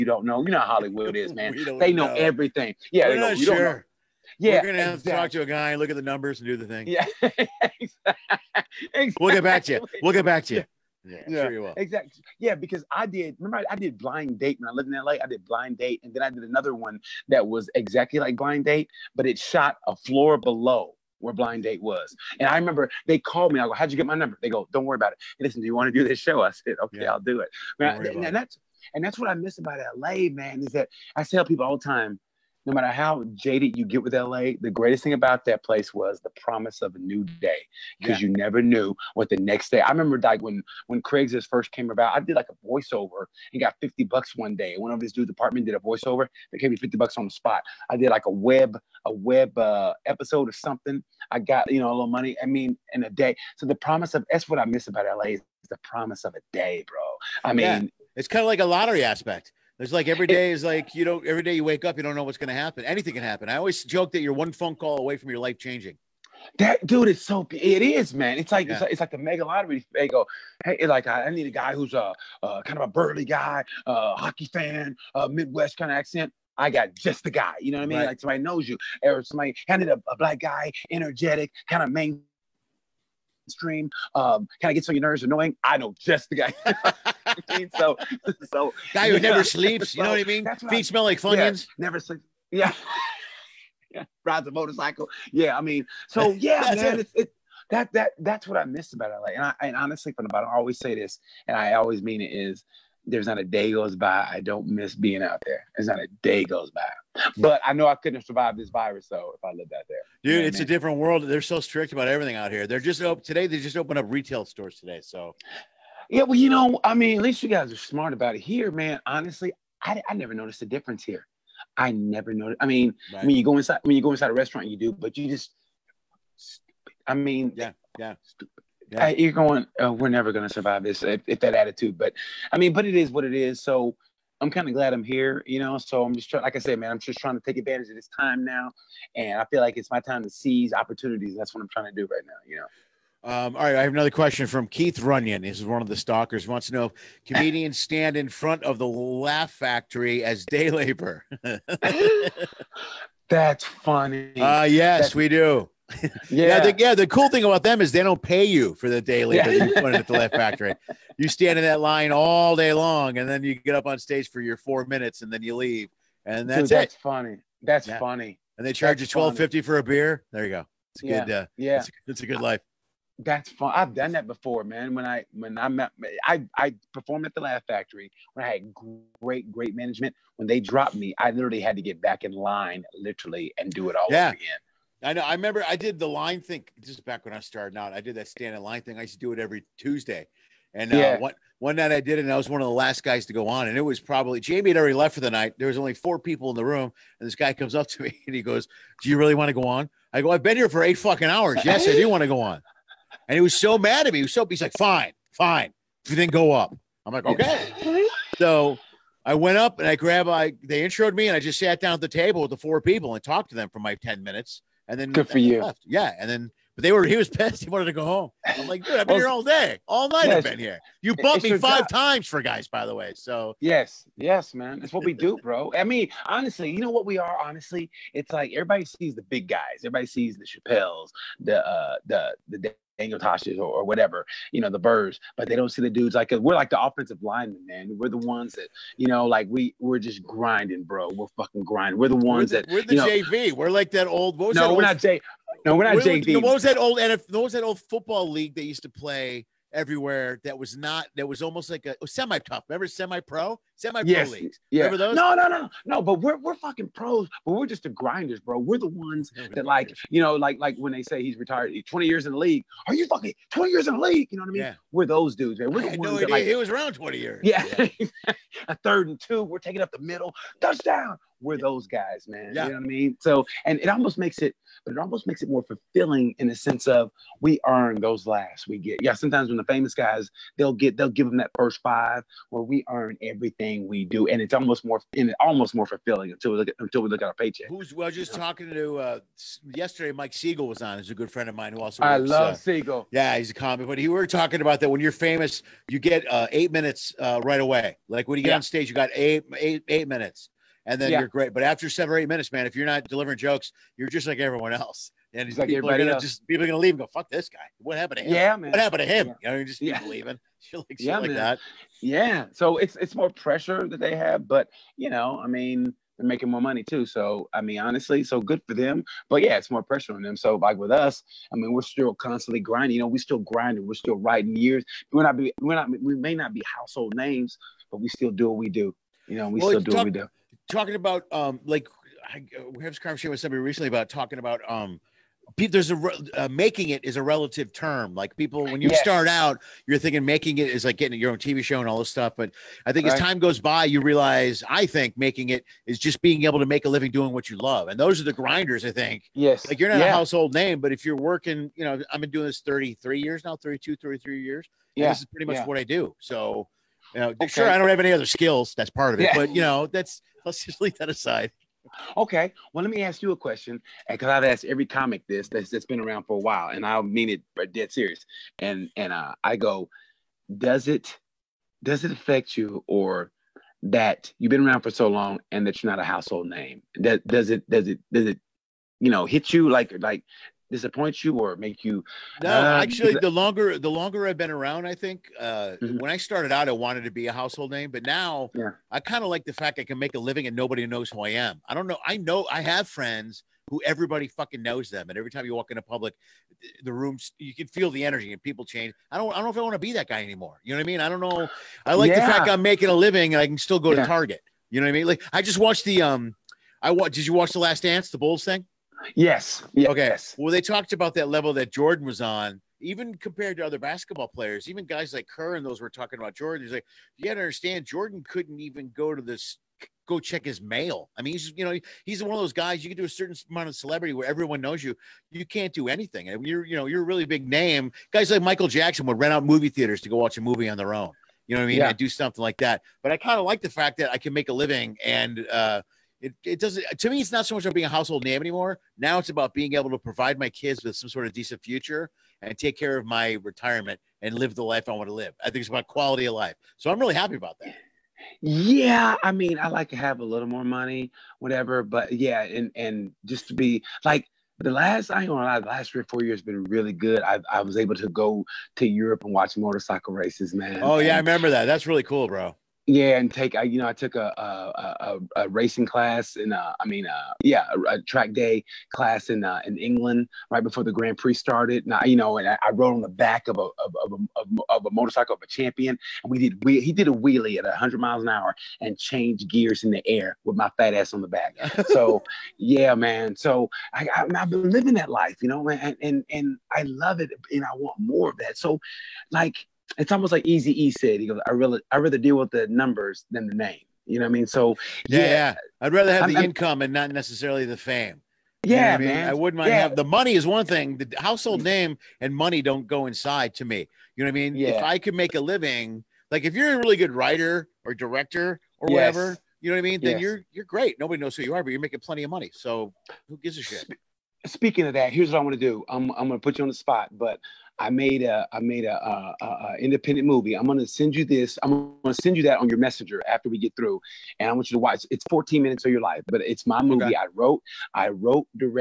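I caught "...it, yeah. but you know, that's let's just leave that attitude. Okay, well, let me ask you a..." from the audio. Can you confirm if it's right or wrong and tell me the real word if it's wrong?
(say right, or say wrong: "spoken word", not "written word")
wrong: "aside", not "attitude".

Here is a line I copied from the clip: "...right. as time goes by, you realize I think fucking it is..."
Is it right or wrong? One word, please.
wrong.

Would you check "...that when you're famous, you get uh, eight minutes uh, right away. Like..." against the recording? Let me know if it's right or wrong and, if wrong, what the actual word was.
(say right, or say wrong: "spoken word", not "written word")
right.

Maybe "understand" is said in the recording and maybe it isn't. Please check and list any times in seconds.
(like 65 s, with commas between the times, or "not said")
417 s.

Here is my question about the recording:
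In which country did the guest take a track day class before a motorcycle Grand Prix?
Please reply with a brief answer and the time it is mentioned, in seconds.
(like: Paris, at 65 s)
England, at 469 s.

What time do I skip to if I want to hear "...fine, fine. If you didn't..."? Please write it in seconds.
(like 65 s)
204 s.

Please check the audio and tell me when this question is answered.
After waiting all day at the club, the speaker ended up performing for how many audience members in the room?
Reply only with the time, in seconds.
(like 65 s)
195 s.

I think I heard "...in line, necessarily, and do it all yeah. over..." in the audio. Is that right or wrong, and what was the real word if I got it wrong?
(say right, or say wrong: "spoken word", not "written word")
wrong: "literally", not "necessarily".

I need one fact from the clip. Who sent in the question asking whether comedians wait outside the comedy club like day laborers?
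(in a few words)
Keith Runyon.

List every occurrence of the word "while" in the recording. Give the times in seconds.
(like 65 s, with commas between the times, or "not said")
366 s.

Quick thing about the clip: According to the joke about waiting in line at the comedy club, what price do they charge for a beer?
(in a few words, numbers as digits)
twelve fifty.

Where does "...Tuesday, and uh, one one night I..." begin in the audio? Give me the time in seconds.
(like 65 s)
189 s.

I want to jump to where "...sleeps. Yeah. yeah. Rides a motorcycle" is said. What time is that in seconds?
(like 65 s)
91 s.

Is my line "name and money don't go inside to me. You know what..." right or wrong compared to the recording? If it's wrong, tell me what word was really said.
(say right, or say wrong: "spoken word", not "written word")
right.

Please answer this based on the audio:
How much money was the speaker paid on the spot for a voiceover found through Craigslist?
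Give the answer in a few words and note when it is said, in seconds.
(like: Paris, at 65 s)
50 bucks, at 43 s.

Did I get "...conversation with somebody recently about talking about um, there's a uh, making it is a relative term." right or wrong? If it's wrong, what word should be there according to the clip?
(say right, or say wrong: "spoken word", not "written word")
right.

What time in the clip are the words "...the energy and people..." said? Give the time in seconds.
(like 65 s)
397 s.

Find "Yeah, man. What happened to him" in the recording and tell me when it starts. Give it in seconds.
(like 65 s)
308 s.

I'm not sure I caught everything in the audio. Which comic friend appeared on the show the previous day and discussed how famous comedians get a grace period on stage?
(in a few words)
Mike Siegel.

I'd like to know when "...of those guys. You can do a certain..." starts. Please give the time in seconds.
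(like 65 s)
422 s.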